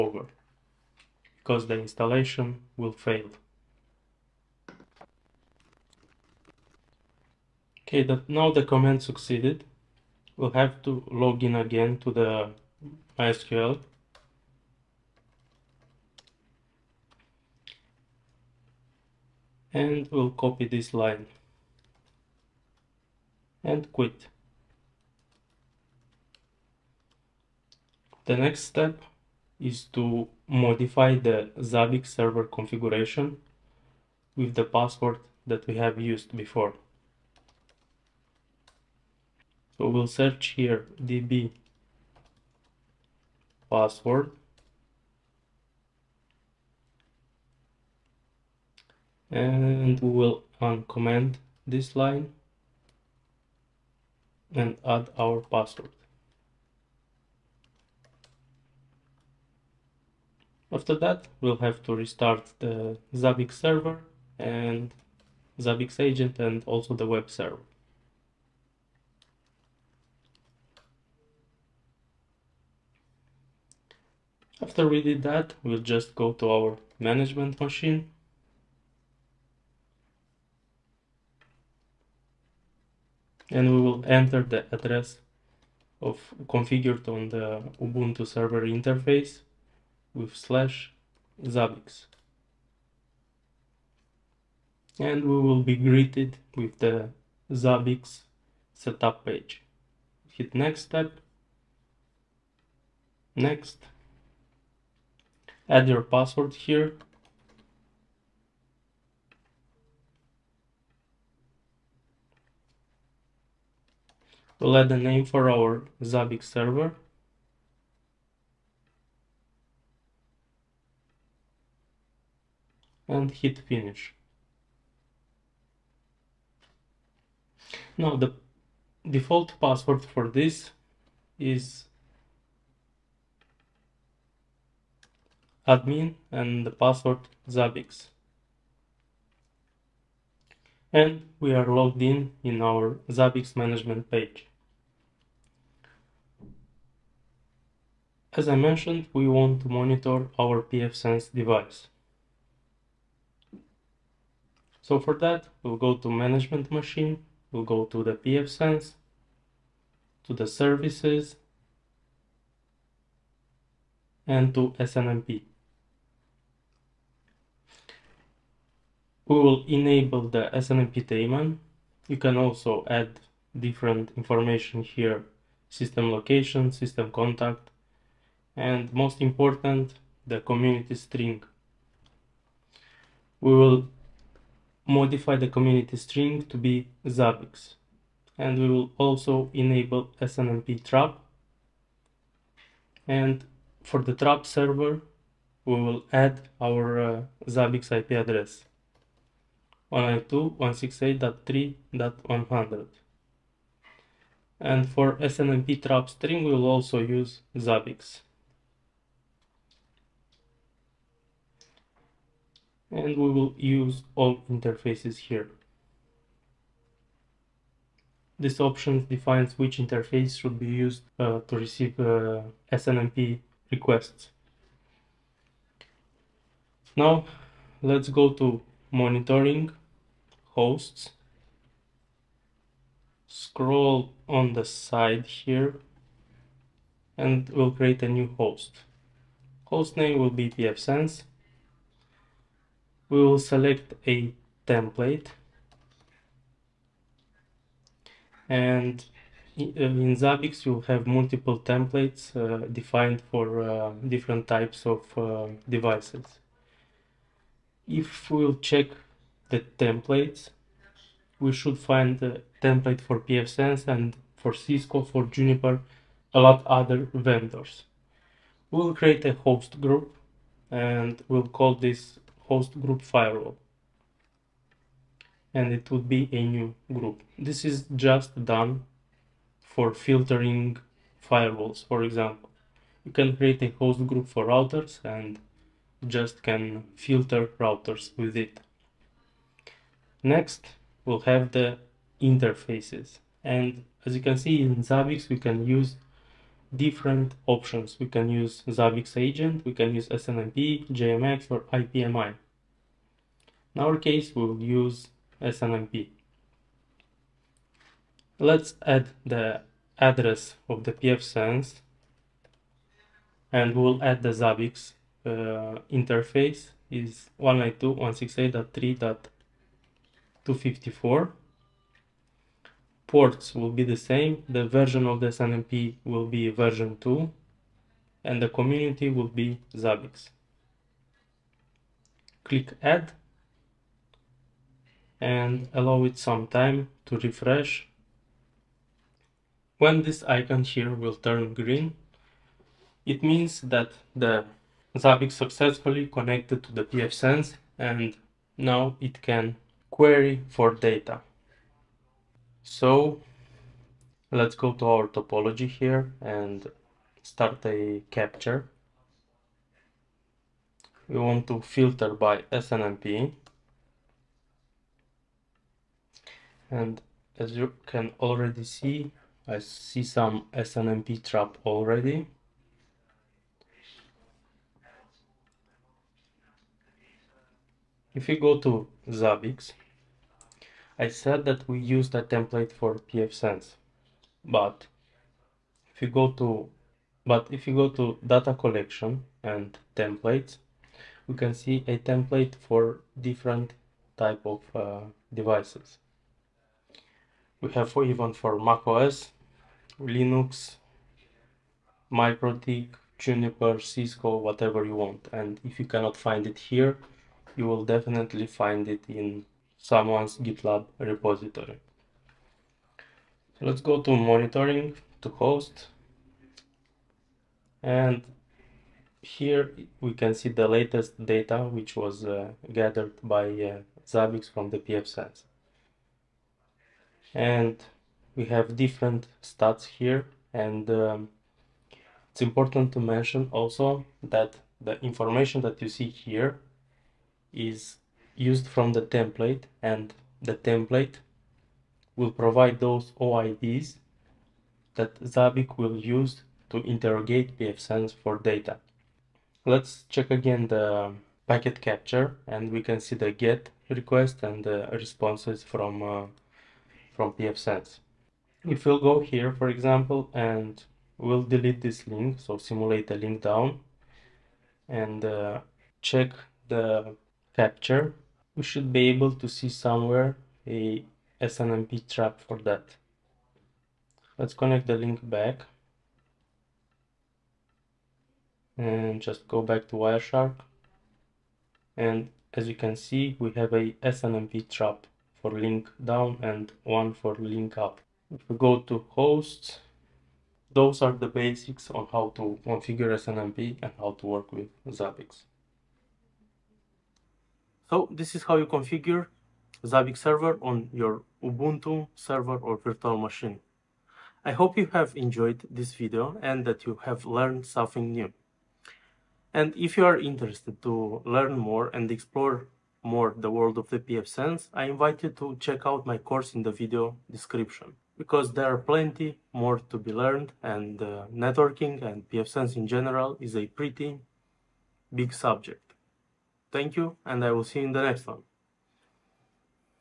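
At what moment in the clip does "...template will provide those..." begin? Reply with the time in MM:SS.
07:20.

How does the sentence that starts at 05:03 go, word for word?
In our case, we will use SNMP.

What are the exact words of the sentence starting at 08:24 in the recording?
I hope you have enjoyed this video and that you have learned something new.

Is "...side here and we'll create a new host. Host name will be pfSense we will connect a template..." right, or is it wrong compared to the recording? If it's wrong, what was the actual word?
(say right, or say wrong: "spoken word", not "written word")
wrong: "select", not "connect".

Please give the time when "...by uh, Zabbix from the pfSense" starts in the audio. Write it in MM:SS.
07:03.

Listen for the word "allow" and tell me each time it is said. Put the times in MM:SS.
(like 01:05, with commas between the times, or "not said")
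05:35.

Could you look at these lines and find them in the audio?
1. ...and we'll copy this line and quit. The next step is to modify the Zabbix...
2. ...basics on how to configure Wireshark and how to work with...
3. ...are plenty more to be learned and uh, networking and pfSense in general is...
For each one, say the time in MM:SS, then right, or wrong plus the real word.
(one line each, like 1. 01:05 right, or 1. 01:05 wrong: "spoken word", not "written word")
1. 00:19 right
2. 08:11 wrong: "SNMP", not "Wireshark"
3. 08:38 right.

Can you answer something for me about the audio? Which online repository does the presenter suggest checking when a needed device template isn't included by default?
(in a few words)
GitLab.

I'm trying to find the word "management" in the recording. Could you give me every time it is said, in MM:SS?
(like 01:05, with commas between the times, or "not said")
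01:16, 02:23, 02:36.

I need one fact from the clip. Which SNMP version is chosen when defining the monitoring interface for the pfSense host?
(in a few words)
version 2.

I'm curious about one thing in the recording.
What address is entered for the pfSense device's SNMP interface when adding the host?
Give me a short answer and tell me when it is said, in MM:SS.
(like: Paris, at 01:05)
192.168.3.254, at 05:17.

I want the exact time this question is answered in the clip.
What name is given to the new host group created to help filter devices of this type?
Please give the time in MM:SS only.
04:33.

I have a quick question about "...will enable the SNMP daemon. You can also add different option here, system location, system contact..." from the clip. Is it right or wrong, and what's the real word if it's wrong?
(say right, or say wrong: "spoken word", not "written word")
wrong: "information", not "option".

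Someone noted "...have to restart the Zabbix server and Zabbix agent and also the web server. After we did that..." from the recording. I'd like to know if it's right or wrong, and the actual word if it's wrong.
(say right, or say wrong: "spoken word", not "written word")
right.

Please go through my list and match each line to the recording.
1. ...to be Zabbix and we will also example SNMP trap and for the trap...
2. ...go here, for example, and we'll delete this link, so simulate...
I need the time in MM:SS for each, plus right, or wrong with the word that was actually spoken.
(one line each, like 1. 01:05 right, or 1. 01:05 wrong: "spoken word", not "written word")
1. 03:06 wrong: "enable", not "example"
2. 07:38 right.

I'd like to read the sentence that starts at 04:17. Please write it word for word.
If we'll check the templates, we should find the template for pfSense and for Cisco, for Juniper, a lot other vendors.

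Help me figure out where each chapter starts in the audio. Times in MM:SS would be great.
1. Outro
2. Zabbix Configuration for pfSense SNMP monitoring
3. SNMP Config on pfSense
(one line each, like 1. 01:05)
1. 08:17
2. 03:46
3. 02:29.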